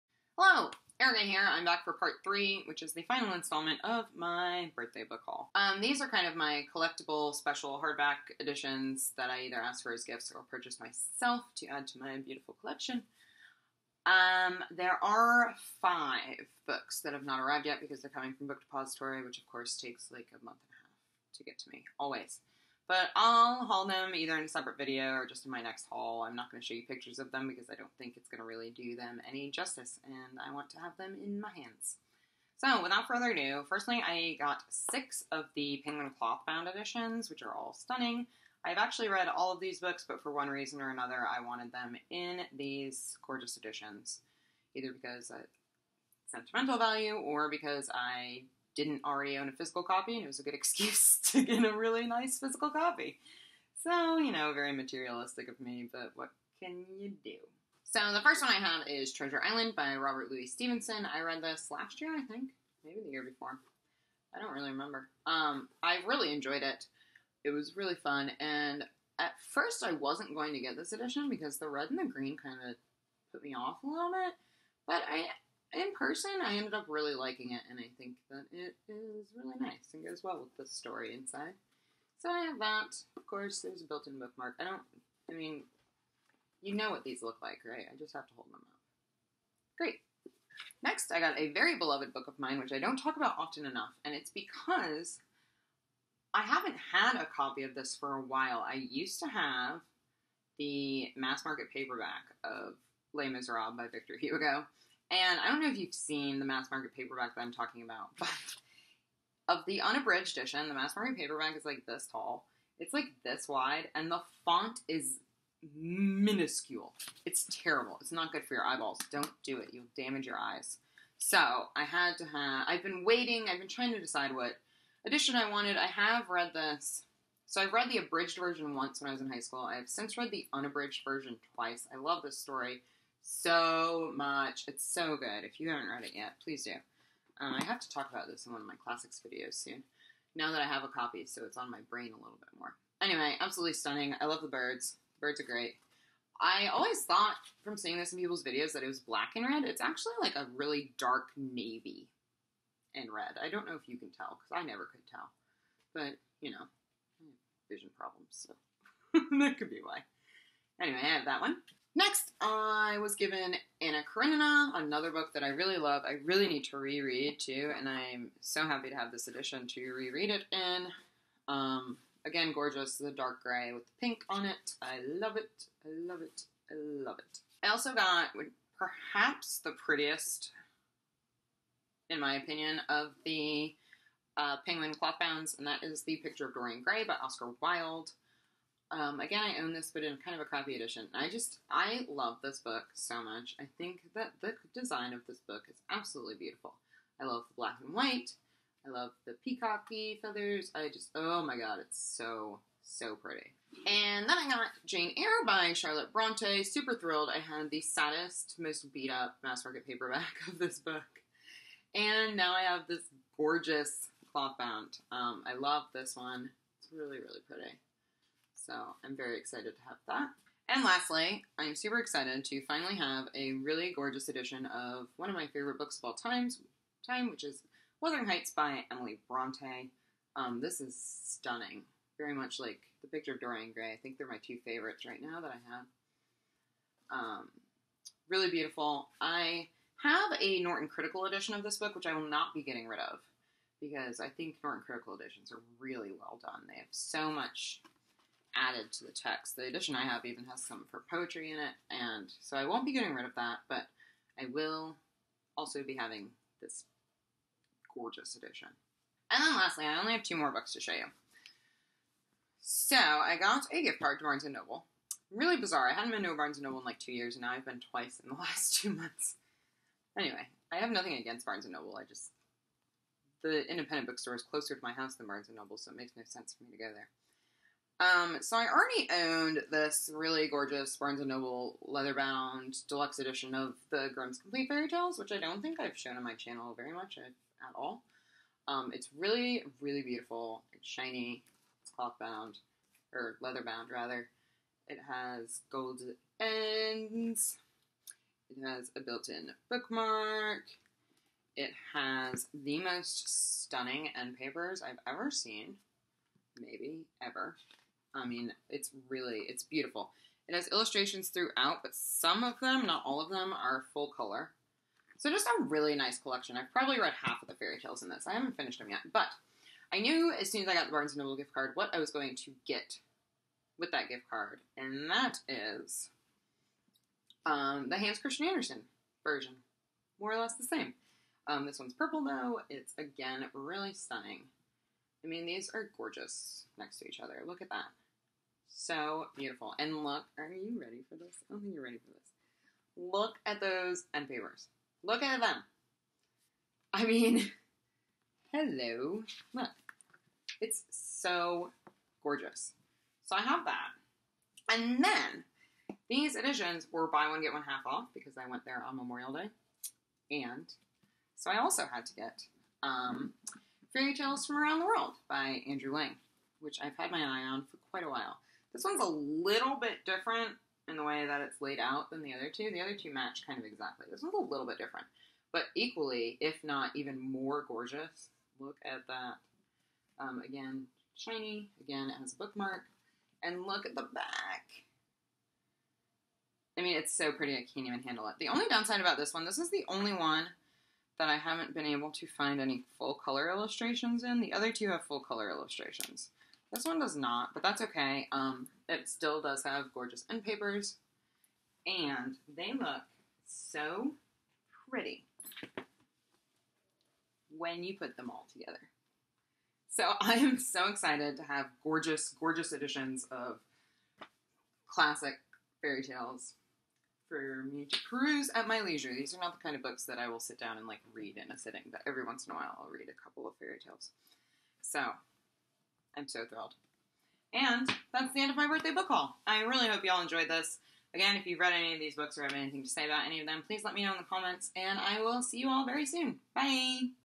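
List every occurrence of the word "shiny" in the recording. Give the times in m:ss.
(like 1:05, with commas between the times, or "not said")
4:50, 6:21.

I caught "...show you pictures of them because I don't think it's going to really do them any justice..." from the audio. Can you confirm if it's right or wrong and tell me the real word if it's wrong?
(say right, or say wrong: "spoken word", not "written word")
right.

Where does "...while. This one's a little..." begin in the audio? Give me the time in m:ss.
6:08.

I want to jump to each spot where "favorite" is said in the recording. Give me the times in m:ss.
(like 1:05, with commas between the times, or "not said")
3:45, 3:54.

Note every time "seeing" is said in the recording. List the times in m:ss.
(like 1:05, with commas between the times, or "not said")
2:27.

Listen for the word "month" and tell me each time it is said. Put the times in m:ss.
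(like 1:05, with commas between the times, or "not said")
0:20, 4:28.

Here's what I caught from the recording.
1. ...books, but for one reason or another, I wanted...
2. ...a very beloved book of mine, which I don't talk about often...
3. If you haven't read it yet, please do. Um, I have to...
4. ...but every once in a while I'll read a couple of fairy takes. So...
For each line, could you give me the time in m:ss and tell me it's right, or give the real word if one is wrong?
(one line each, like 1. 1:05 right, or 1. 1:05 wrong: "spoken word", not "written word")
1. 0:39 right
2. 1:31 right
3. 2:15 right
4. 7:01 wrong: "tales", not "takes".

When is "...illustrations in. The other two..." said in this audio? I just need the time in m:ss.
6:33.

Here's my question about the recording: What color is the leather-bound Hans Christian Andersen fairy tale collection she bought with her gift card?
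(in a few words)
purple.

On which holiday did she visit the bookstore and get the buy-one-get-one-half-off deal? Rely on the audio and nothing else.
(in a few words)
Memorial Day.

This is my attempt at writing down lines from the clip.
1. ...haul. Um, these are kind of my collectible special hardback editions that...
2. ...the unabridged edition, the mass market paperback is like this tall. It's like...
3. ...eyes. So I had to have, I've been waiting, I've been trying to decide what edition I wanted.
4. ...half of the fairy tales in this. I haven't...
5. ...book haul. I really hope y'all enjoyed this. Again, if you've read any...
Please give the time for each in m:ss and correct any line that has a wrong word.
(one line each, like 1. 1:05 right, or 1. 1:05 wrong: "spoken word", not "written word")
1. 0:05 right
2. 1:49 right
3. 2:00 right
4. 5:17 right
5. 7:08 right.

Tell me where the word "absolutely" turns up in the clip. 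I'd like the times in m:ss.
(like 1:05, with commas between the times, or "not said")
2:23, 3:15.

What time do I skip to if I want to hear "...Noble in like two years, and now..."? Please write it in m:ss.
4:26.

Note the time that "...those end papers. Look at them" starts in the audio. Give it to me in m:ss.
5:43.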